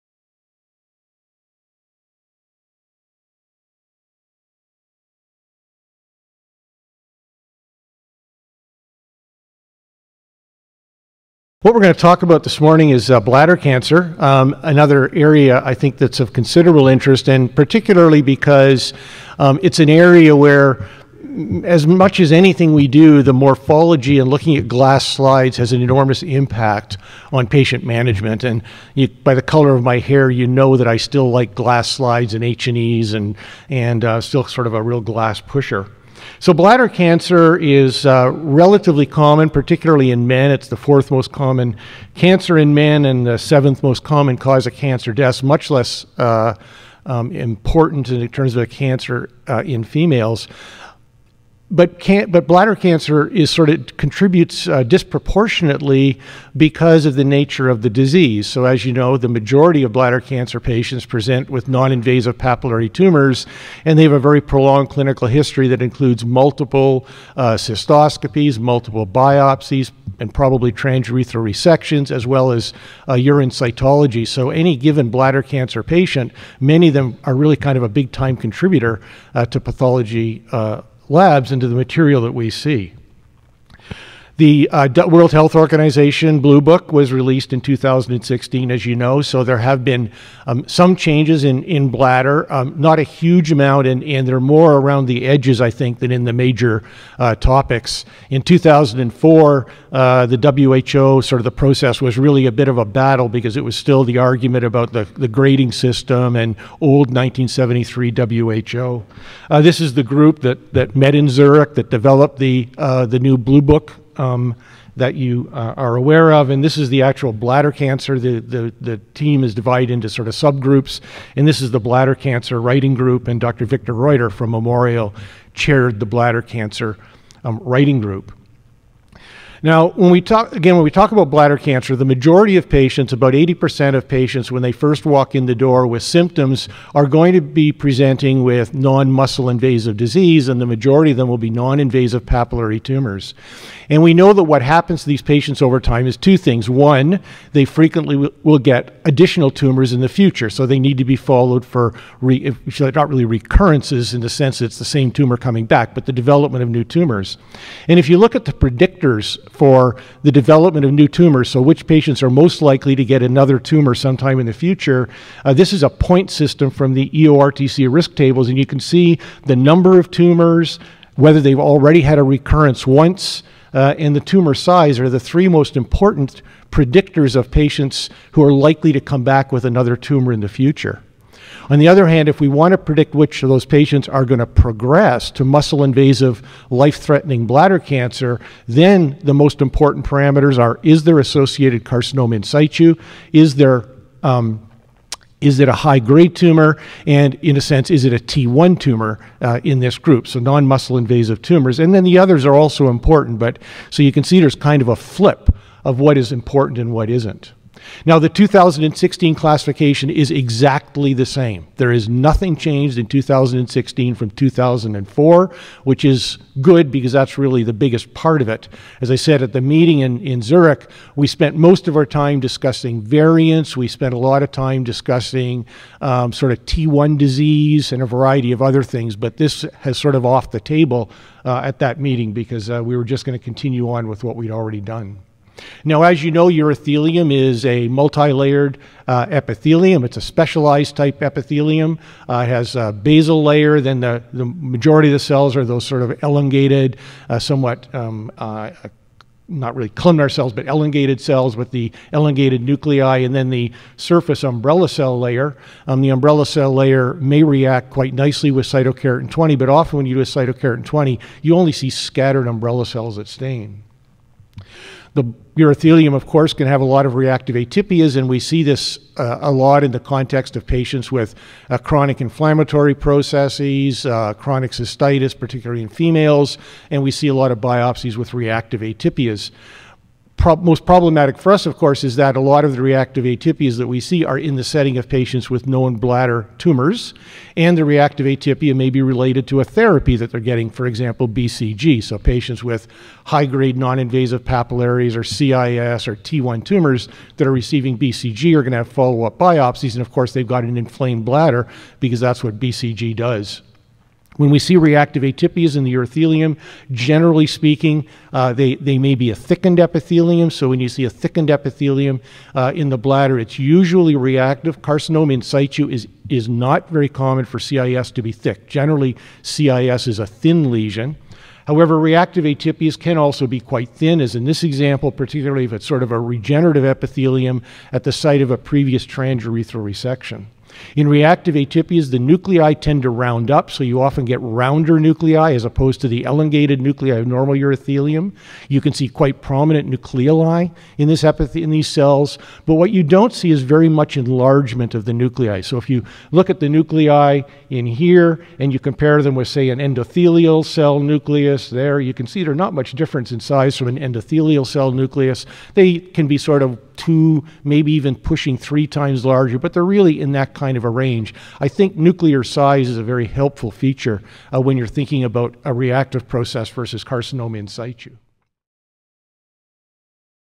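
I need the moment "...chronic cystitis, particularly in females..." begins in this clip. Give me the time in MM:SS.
04:34.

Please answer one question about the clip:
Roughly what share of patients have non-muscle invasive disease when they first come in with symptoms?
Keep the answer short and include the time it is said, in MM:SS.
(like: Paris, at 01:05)
80%, at 02:13.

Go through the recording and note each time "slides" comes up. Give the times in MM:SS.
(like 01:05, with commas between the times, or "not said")
00:25, 00:31.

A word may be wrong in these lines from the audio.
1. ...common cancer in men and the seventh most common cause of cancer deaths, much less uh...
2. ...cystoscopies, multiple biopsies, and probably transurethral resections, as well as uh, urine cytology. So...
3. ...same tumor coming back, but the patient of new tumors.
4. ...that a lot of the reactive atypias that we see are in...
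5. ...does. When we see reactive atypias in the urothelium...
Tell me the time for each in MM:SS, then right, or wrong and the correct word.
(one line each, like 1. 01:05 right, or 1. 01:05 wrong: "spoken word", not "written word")
1. 00:41 right
2. 01:07 right
3. 02:34 wrong: "development", not "patient"
4. 04:42 right
5. 05:03 right.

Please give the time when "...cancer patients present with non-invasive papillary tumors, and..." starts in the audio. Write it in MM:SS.
01:00.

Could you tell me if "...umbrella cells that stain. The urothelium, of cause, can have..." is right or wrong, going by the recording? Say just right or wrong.
wrong.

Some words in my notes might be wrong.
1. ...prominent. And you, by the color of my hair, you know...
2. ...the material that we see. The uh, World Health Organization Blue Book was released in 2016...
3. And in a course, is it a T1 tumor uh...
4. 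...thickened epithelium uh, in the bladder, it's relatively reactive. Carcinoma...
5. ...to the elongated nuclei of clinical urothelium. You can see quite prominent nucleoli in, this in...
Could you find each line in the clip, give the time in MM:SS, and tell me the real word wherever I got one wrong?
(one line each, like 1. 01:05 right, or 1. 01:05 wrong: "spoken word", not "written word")
1. 00:27 wrong: "management", not "prominent"
2. 01:21 right
3. 03:17 wrong: "sense", not "course"
4. 05:11 wrong: "usually", not "relatively"
5. 05:36 wrong: "normal", not "clinical".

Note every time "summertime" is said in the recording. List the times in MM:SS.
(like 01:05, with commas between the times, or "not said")
not said.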